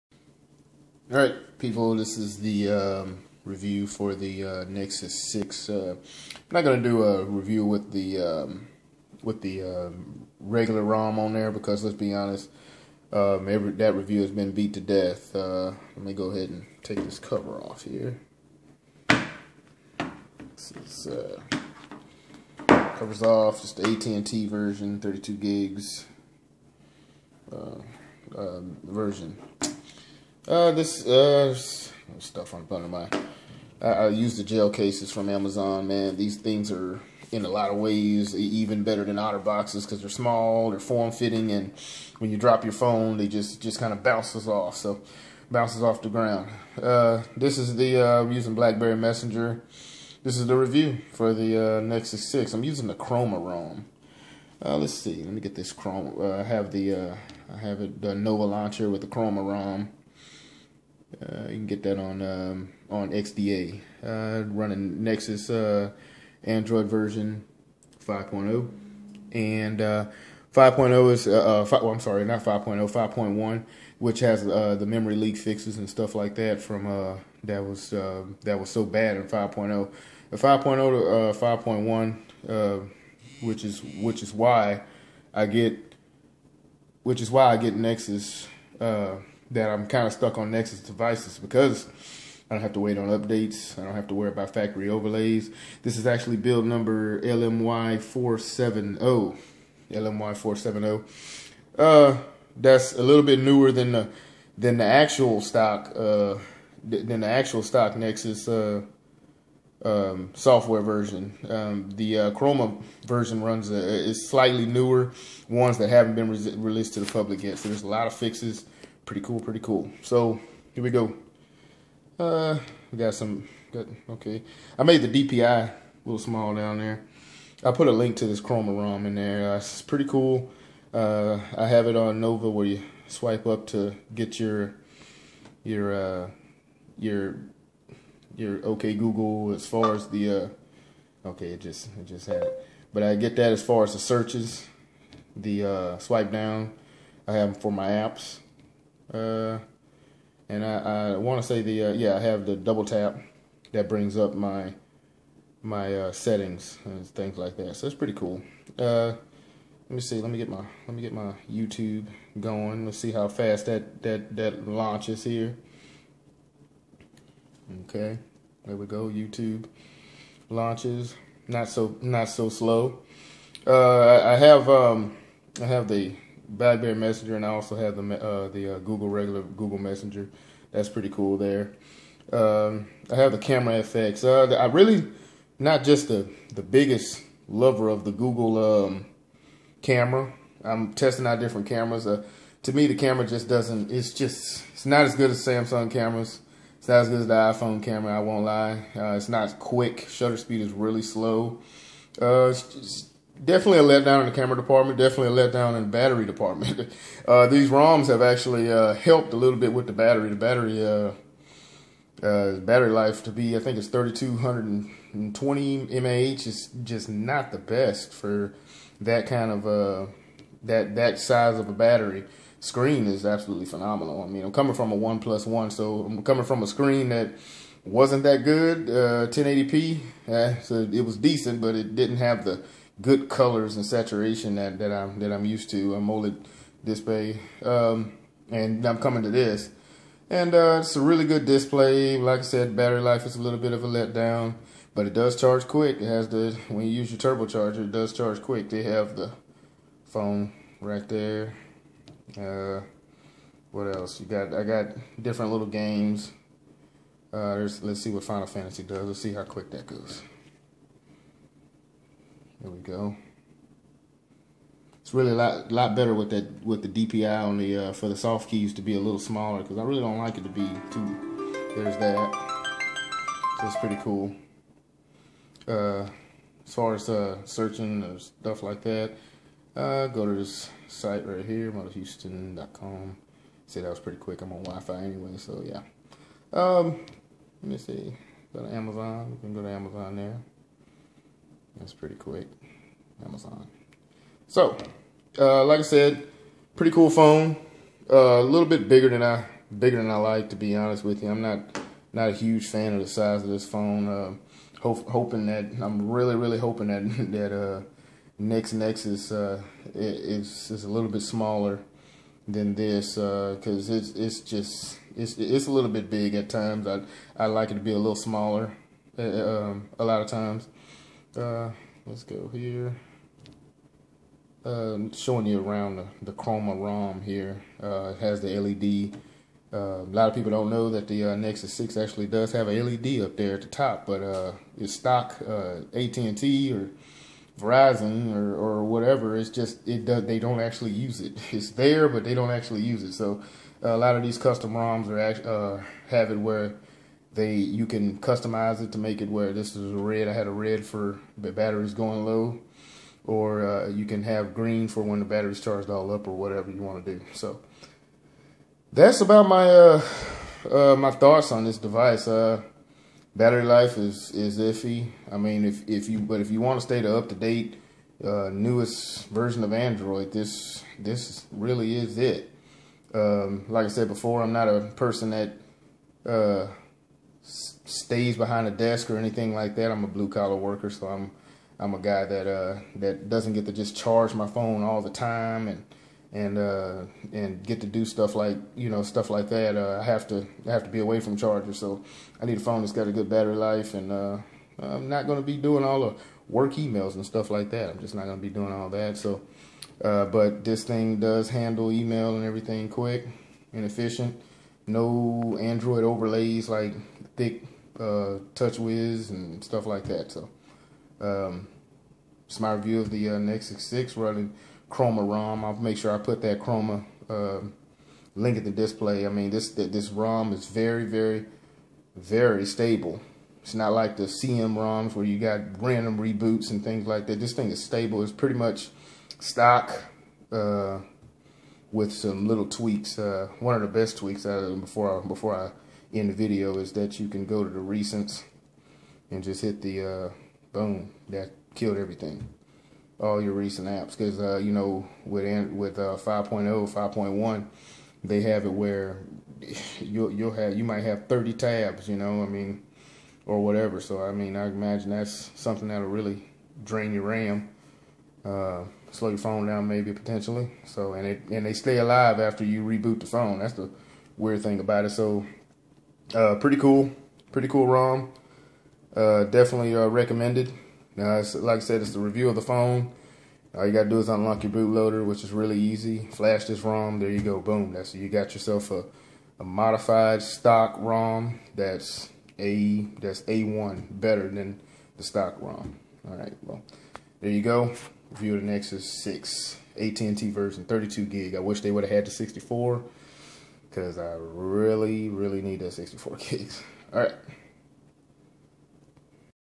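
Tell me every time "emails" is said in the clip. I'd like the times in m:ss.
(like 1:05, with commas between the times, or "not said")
6:36, 6:41.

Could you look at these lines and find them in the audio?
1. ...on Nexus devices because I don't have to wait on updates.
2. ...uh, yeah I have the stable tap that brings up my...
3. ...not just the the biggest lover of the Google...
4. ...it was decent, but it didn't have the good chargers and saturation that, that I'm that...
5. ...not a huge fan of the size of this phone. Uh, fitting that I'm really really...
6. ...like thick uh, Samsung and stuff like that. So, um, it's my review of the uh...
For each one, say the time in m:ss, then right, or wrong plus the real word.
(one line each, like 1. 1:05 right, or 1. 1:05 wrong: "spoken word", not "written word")
1. 1:30 right
2. 2:31 wrong: "double", not "stable"
3. 3:05 right
4. 3:50 wrong: "colors", not "chargers"
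5. 5:02 wrong: "hoping", not "fitting"
6. 6:46 wrong: "TouchWiz", not "Samsung".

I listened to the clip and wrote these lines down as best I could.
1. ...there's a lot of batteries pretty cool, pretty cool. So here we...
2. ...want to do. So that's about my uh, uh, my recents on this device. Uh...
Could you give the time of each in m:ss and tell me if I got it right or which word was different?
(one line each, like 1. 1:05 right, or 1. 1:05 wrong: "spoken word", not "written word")
1. 1:57 wrong: "fixes", not "batteries"
2. 5:56 wrong: "thoughts", not "recents".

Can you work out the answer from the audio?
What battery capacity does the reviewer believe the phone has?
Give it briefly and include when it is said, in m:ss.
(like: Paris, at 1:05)
3220 mAh, at 3:33.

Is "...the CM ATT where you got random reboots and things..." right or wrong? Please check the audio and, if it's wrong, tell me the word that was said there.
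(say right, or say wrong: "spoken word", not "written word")
wrong: "ROMs", not "ATT".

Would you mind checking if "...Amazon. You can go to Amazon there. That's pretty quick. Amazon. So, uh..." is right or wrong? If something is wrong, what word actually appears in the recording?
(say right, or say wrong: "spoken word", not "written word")
right.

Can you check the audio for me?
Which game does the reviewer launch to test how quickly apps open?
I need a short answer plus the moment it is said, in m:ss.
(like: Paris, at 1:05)
Final Fantasy, at 4:18.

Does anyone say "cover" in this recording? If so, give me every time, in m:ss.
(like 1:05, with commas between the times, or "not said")
0:17, 0:22.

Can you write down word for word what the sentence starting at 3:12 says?
Uh, to me, the camera just doesn't.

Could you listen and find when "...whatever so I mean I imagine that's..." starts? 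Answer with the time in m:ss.
7:33.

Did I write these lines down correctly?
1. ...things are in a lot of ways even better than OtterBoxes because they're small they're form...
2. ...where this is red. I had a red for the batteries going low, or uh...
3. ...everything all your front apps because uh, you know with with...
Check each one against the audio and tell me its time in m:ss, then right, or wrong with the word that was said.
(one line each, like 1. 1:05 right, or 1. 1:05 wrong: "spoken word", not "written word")
1. 0:36 right
2. 5:49 right
3. 7:21 wrong: "recent", not "front".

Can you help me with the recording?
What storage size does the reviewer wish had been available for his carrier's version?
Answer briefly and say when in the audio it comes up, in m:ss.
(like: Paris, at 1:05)
64 gigs, at 8:15.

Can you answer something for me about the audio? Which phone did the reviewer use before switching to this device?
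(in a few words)
OnePlus One.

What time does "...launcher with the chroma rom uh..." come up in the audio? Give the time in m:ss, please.
0:58.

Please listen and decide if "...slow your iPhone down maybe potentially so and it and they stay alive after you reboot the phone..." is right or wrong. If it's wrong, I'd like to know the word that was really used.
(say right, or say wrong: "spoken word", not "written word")
wrong: "phone", not "iPhone".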